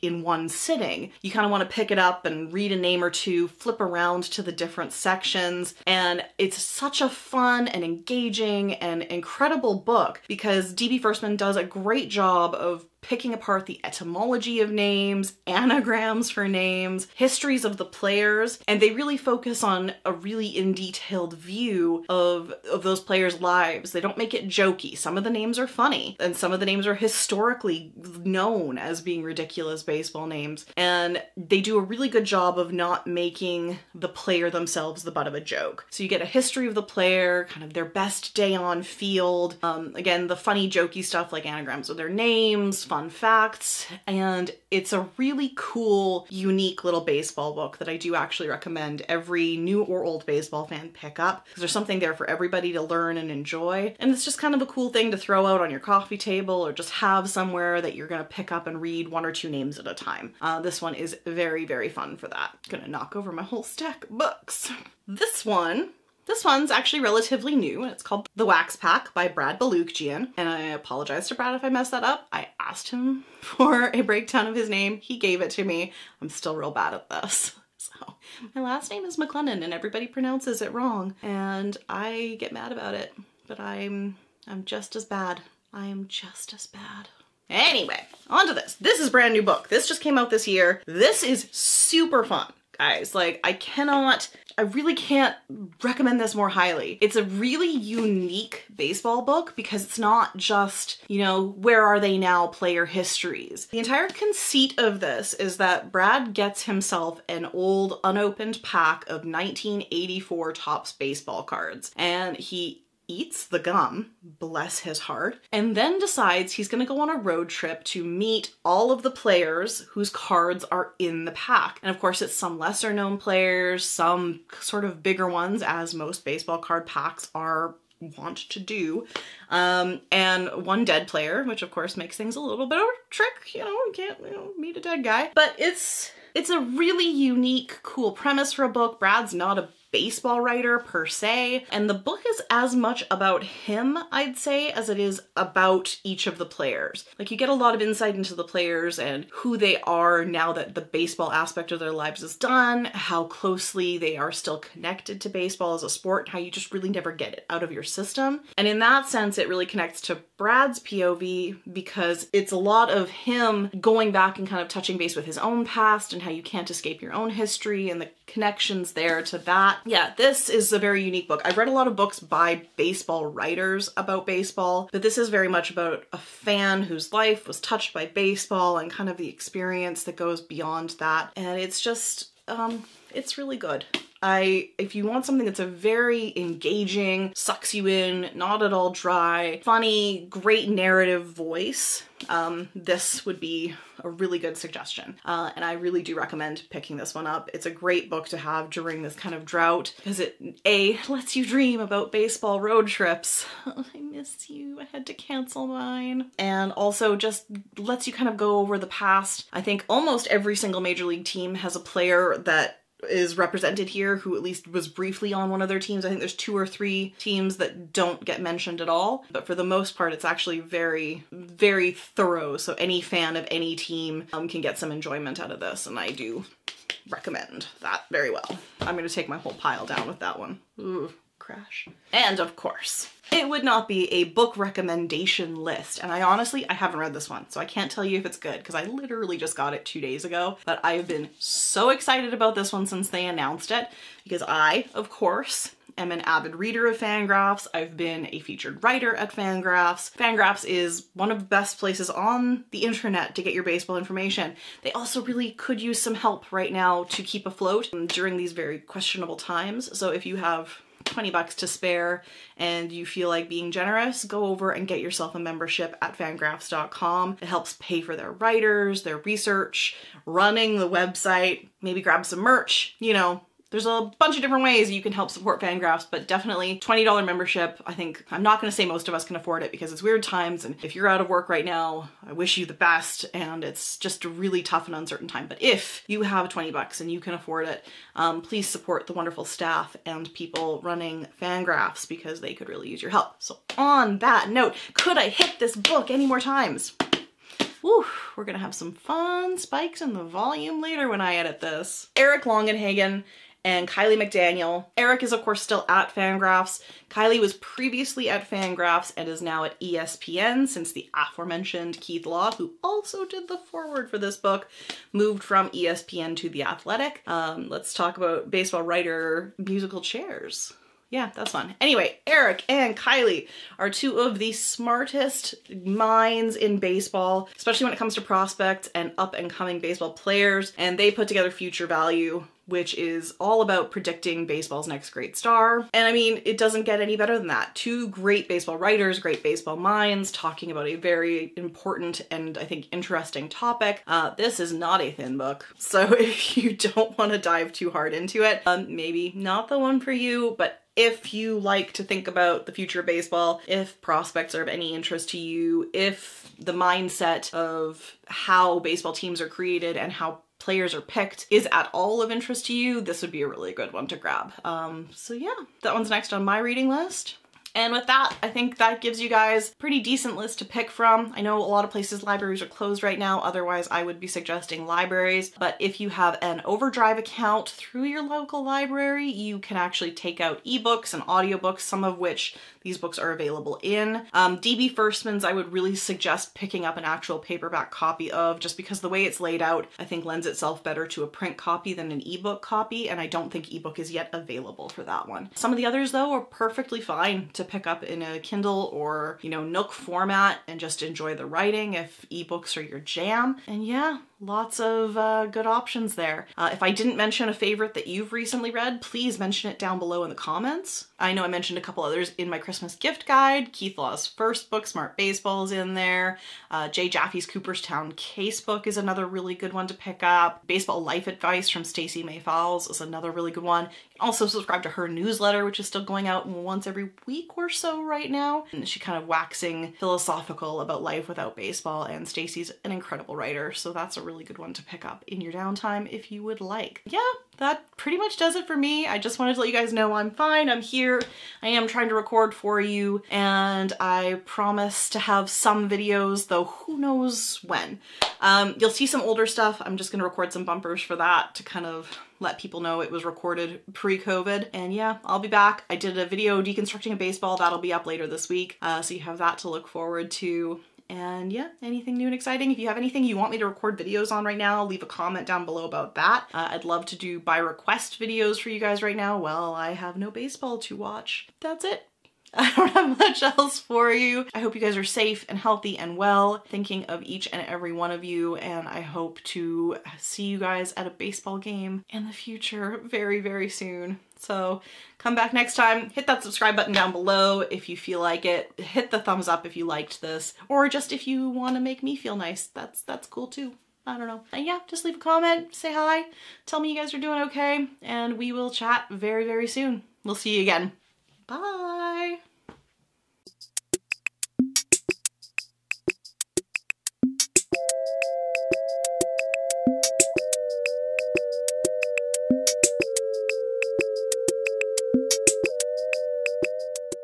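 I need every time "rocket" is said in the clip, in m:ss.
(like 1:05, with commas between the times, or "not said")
not said.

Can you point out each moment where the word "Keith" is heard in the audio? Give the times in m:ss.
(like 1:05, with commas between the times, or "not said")
5:12, 6:53.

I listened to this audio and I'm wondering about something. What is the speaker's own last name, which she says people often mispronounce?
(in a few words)
MacLennan.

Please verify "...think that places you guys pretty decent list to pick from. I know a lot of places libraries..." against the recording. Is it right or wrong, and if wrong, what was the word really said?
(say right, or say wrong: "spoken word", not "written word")
wrong: "gives", not "places".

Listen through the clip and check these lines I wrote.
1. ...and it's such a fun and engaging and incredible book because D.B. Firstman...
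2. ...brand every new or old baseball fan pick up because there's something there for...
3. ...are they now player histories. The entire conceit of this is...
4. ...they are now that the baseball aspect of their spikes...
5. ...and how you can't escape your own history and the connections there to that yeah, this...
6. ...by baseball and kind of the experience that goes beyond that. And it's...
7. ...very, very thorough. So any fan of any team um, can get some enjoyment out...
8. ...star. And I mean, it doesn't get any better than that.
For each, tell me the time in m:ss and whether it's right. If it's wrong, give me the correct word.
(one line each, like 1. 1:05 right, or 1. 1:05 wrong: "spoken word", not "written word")
1. 0:05 right
2. 0:48 wrong: "recommend", not "brand"
3. 1:41 right
4. 2:29 wrong: "lives", not "spikes"
5. 2:46 right
6. 2:57 right
7. 3:40 right
8. 5:35 right.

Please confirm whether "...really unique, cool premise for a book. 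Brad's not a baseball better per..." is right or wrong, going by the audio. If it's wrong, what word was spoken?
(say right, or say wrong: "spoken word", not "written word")
wrong: "writer", not "better".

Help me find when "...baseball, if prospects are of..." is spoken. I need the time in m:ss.
5:53.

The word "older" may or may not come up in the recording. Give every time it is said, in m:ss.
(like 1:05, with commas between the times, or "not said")
7:29.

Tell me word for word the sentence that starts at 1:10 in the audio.
And I apologize to Brad if I messed that up.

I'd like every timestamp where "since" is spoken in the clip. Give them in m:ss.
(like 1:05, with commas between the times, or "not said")
4:02, 5:10.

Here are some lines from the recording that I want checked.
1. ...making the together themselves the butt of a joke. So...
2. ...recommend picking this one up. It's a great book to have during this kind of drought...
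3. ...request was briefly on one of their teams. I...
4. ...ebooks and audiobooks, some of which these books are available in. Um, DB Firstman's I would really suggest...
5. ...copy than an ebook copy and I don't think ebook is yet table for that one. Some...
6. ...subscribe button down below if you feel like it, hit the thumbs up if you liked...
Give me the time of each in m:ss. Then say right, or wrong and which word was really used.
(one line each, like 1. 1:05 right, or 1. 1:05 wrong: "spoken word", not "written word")
1. 0:33 wrong: "player", not "together"
2. 3:16 right
3. 3:34 wrong: "least", not "request"
4. 6:20 right
5. 6:31 wrong: "available", not "table"
6. 8:06 right.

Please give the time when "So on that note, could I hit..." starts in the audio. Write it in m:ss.
4:53.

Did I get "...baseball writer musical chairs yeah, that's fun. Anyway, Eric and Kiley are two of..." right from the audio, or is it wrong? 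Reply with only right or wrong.
right.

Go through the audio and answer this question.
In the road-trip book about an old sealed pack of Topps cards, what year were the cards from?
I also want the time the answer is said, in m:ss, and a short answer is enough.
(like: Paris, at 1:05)
1984, at 1:49.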